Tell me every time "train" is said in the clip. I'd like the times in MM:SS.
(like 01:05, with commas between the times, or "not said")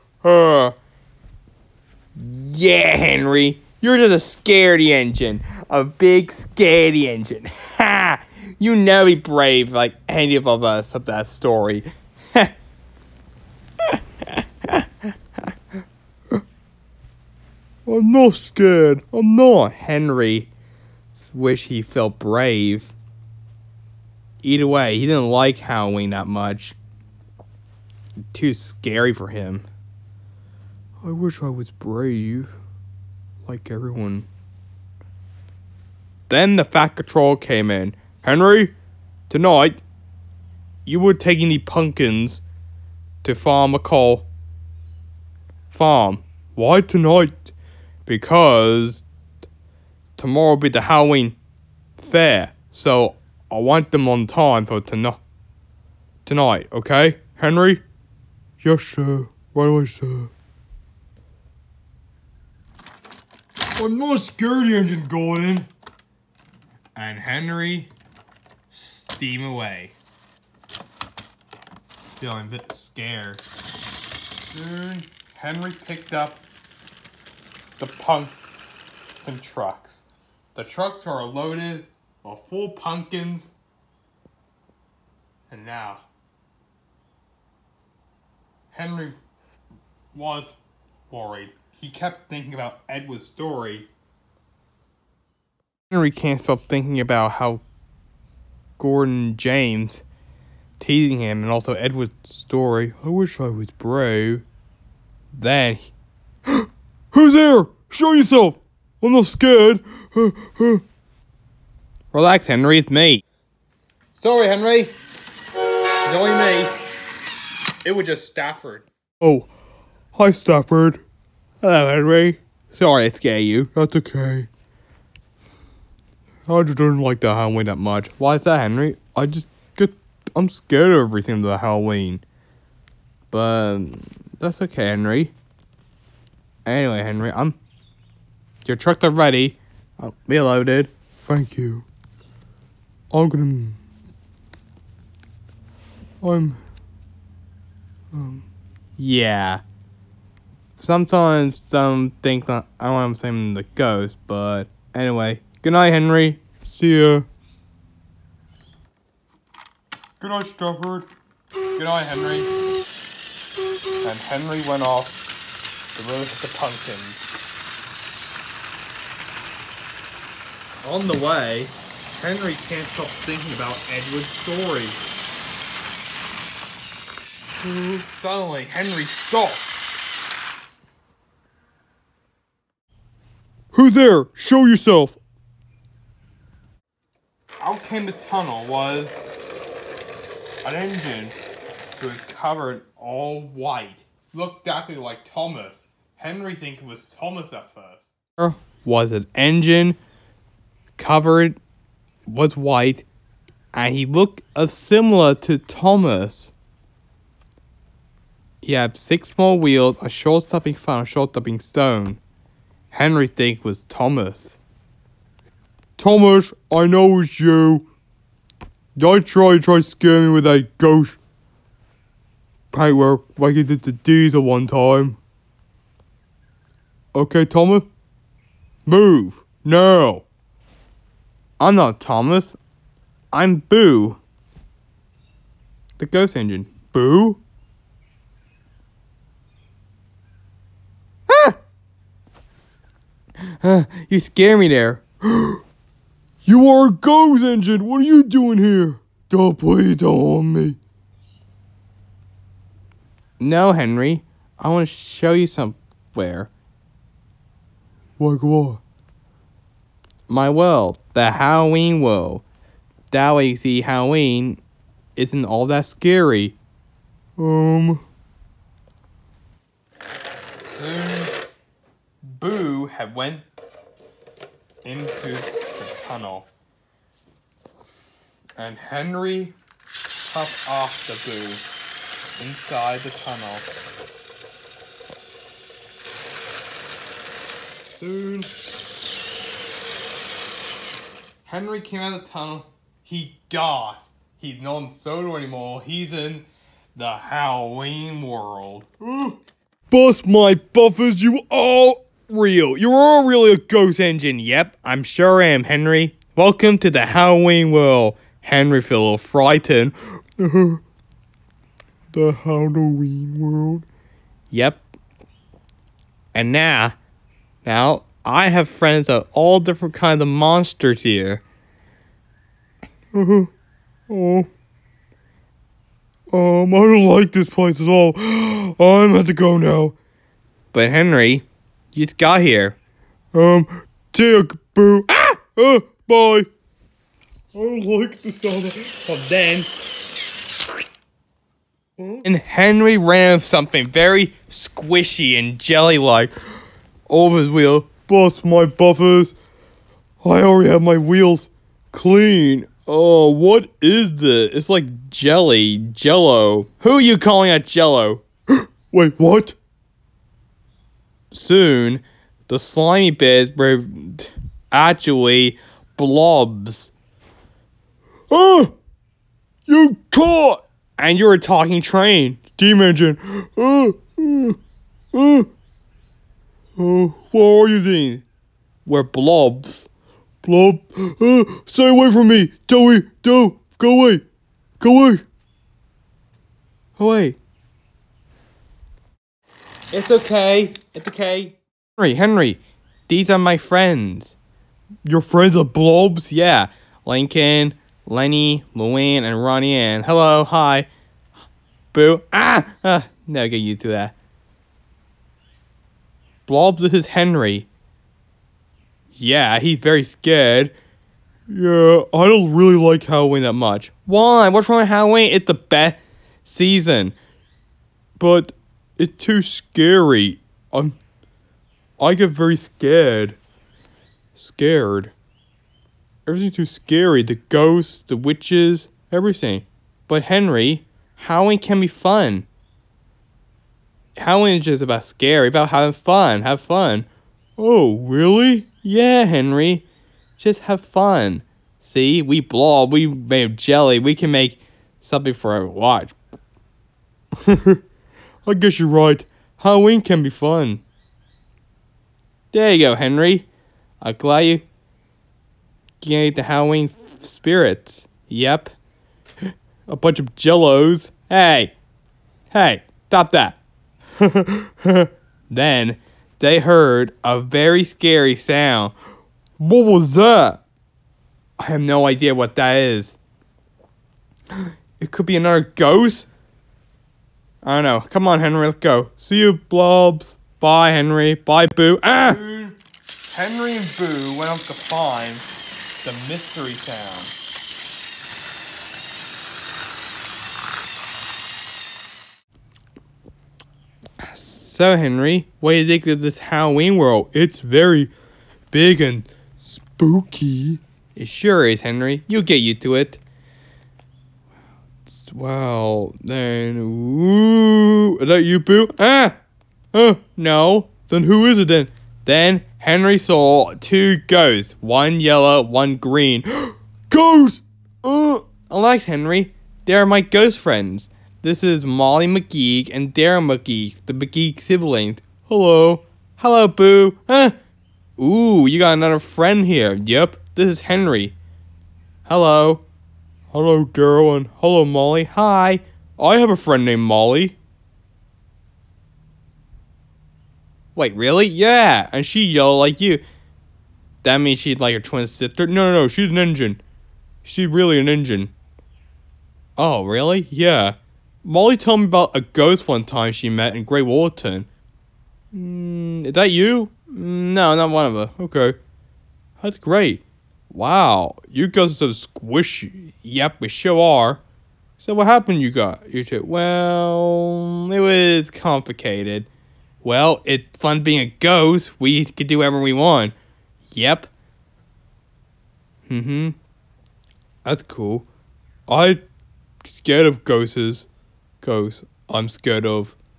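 06:11.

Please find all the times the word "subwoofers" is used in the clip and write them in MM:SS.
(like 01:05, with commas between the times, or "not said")
not said.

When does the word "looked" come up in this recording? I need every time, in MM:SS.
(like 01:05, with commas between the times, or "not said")
03:14, 03:24.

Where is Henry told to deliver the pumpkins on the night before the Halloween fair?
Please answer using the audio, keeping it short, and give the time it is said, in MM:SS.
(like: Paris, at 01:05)
Farm McColl, at 00:43.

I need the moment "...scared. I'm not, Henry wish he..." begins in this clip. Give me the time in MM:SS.
00:18.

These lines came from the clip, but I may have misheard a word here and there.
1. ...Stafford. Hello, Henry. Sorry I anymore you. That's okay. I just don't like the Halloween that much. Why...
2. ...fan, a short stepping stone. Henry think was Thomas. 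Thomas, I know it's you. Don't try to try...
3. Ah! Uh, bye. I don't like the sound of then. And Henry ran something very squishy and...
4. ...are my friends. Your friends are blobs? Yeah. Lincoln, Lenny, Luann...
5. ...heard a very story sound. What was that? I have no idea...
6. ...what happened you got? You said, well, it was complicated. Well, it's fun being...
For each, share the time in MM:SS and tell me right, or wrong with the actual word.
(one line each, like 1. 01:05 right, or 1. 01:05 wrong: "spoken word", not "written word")
1. 02:00 wrong: "scare", not "anymore"
2. 03:30 right
3. 05:35 right
4. 06:33 right
5. 07:46 wrong: "scary", not "story"
6. 09:25 right.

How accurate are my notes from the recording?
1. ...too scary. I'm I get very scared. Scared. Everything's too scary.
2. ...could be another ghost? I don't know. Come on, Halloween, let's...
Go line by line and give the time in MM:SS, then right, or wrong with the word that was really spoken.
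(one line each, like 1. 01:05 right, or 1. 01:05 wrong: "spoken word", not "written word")
1. 06:59 right
2. 07:55 wrong: "Henry", not "Halloween".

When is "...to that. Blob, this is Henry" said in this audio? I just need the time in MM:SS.
06:43.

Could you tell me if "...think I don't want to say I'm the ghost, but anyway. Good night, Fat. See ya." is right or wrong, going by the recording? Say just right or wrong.
wrong.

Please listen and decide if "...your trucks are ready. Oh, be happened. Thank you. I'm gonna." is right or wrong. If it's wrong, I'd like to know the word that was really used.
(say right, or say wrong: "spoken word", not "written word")
wrong: "loaded", not "happened".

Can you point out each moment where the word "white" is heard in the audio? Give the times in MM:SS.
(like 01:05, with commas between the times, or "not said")
03:13, 03:22.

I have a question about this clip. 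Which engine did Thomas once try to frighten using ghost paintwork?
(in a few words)
Diesel.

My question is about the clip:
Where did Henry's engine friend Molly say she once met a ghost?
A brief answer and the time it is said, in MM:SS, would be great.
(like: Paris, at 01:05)
Great Waterton, at 09:13.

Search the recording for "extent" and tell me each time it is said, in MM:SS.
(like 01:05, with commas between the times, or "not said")
not said.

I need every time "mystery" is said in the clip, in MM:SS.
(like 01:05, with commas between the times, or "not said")
08:06.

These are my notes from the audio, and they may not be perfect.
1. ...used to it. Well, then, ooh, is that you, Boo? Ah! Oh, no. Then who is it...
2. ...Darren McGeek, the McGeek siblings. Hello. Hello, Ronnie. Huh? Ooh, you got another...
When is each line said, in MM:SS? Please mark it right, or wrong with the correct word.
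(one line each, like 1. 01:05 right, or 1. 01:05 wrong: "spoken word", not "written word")
1. 08:22 right
2. 08:43 wrong: "Boo", not "Ronnie".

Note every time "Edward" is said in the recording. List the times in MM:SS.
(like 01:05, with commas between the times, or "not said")
01:32, 01:41, 02:53.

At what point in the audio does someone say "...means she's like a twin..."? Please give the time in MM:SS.
09:04.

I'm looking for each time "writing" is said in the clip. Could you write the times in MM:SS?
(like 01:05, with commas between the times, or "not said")
not said.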